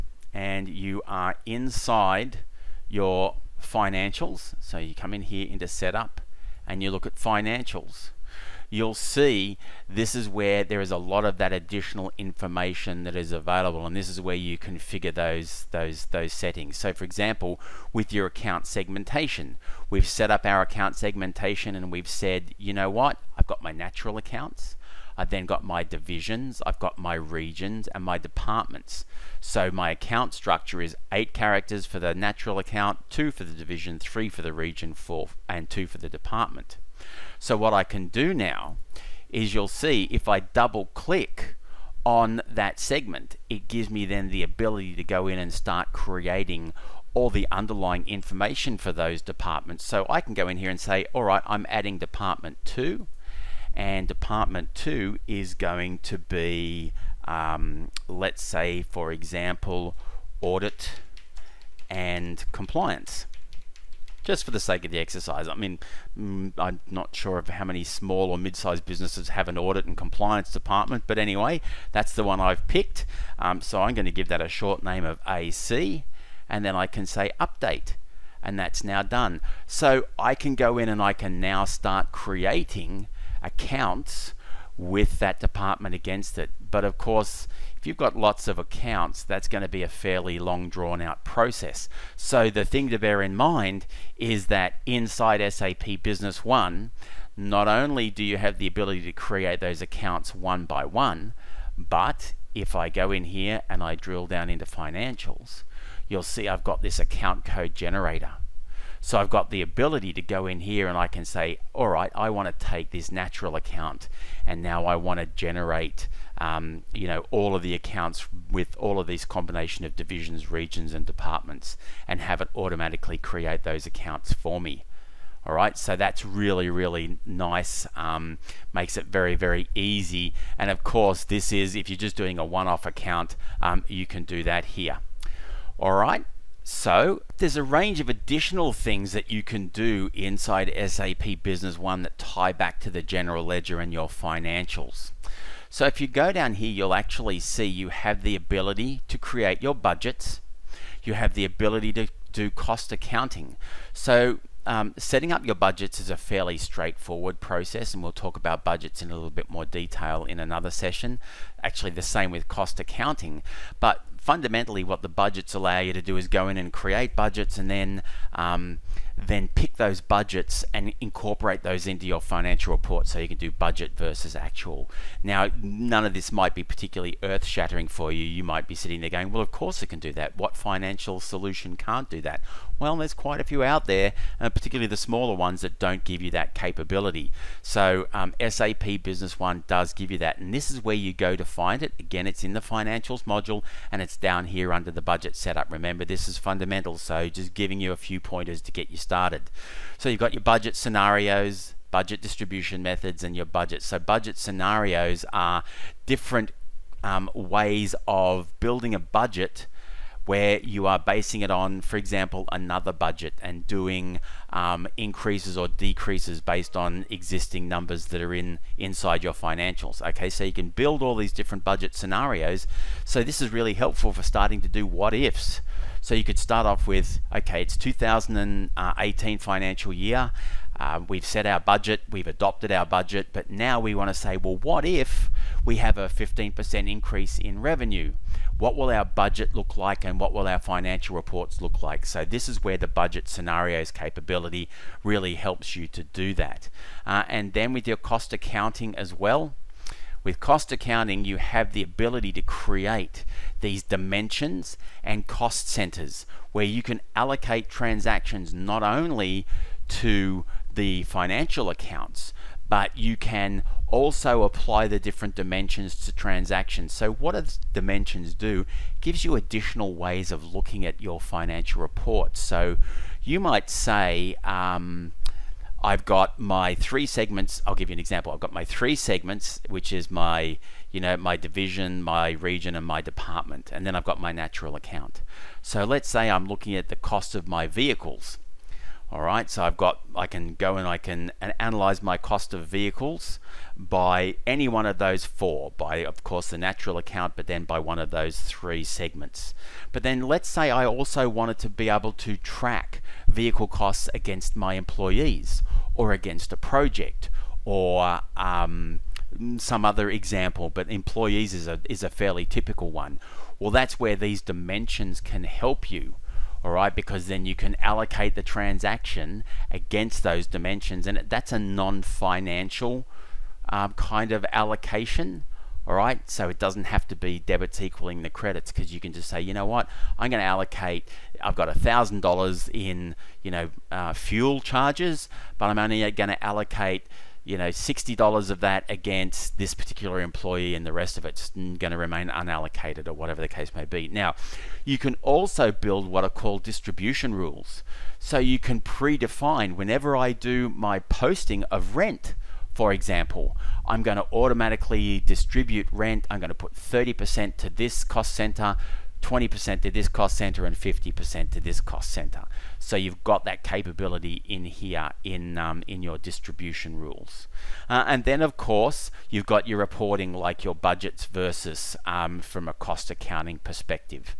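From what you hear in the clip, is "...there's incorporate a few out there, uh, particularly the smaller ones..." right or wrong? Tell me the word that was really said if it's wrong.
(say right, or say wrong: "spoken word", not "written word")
wrong: "quite", not "incorporate".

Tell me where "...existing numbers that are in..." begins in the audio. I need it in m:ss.
3:37.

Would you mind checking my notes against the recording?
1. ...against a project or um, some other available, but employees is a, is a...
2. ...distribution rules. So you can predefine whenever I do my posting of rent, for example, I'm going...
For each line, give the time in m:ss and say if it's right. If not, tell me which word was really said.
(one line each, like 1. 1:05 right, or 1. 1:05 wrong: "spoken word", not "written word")
1. 5:06 wrong: "example", not "available"
2. 5:46 right.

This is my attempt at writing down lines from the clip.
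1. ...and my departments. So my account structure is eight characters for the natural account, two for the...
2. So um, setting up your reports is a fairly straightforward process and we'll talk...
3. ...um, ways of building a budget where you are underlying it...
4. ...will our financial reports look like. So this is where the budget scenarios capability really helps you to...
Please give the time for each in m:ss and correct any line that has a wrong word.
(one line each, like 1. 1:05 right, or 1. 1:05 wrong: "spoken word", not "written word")
1. 0:27 right
2. 2:33 wrong: "budgets", not "reports"
3. 3:27 wrong: "basing", not "underlying"
4. 4:00 right.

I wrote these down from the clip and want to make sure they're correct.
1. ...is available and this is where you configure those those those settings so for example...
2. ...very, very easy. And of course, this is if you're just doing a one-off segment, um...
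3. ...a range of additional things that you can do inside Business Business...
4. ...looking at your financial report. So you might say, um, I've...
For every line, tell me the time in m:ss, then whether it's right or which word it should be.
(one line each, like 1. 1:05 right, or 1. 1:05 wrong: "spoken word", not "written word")
1. 0:13 right
2. 2:09 wrong: "account", not "segment"
3. 2:17 wrong: "SAP", not "Business"
4. 4:30 right.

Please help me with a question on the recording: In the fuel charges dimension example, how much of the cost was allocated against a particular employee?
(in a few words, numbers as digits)
$60.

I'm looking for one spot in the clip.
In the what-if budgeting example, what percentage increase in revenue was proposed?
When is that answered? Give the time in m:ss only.
3:56.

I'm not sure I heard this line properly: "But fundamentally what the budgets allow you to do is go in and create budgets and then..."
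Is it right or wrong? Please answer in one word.
right.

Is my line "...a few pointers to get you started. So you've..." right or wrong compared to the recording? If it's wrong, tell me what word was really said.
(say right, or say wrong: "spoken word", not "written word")
right.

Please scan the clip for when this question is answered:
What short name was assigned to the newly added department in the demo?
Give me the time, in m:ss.
1:15.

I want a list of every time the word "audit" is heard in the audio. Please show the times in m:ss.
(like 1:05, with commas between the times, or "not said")
1:00, 1:09.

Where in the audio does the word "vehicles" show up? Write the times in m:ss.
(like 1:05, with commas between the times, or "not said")
4:47, 4:52, 5:03.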